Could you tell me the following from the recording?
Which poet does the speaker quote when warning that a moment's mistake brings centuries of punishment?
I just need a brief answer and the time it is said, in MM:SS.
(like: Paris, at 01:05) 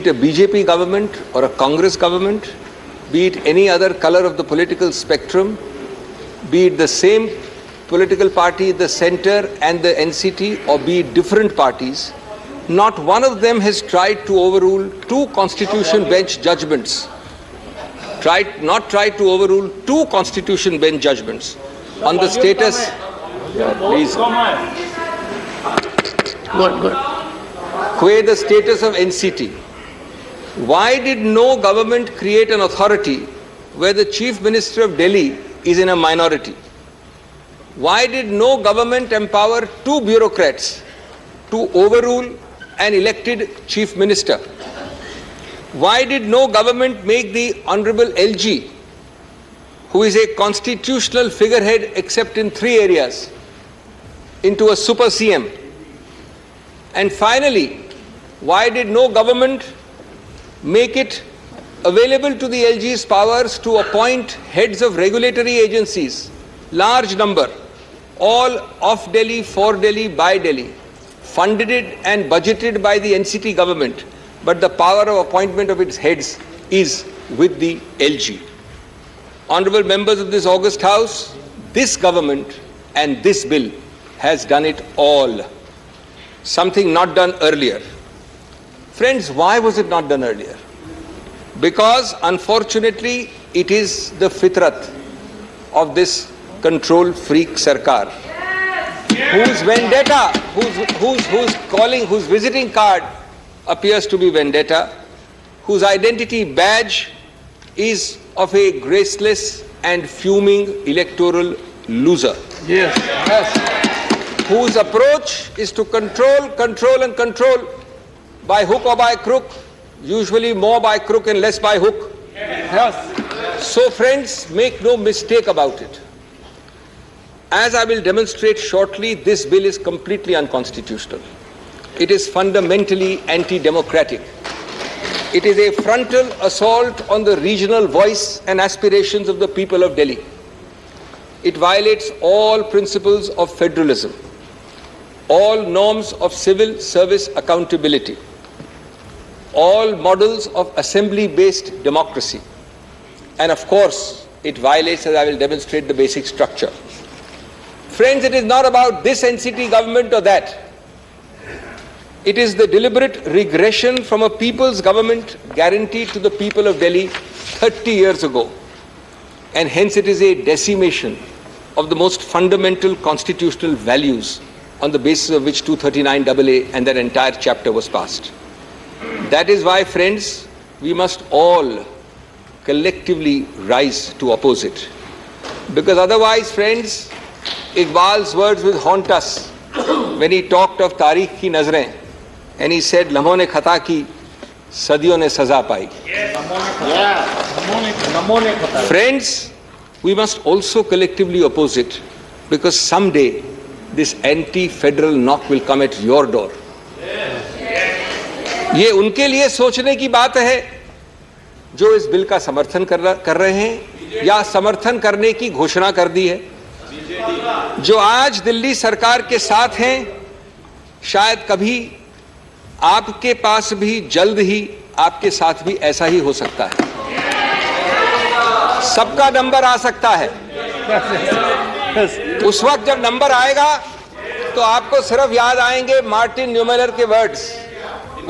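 Iqbal, at 03:07.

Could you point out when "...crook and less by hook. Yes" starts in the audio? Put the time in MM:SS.
02:00.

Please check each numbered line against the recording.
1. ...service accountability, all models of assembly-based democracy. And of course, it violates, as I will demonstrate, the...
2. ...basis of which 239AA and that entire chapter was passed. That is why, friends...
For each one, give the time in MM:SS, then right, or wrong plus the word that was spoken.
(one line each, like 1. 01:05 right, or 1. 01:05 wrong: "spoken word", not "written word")
1. 02:26 right
2. 02:54 right.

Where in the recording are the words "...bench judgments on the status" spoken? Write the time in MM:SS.
00:20.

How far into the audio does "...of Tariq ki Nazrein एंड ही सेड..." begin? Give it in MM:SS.
03:10.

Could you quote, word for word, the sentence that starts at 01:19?
Honorable members of this August House, this government and this bill has done it all.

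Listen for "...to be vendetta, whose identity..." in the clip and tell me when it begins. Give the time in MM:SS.
01:44.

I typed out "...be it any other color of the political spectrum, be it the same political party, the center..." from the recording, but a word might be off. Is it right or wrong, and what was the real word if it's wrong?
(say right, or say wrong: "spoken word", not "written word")
right.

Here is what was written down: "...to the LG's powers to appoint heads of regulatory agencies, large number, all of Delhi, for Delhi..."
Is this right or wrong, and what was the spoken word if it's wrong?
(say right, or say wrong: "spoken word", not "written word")
right.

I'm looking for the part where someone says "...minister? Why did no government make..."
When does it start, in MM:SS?
00:43.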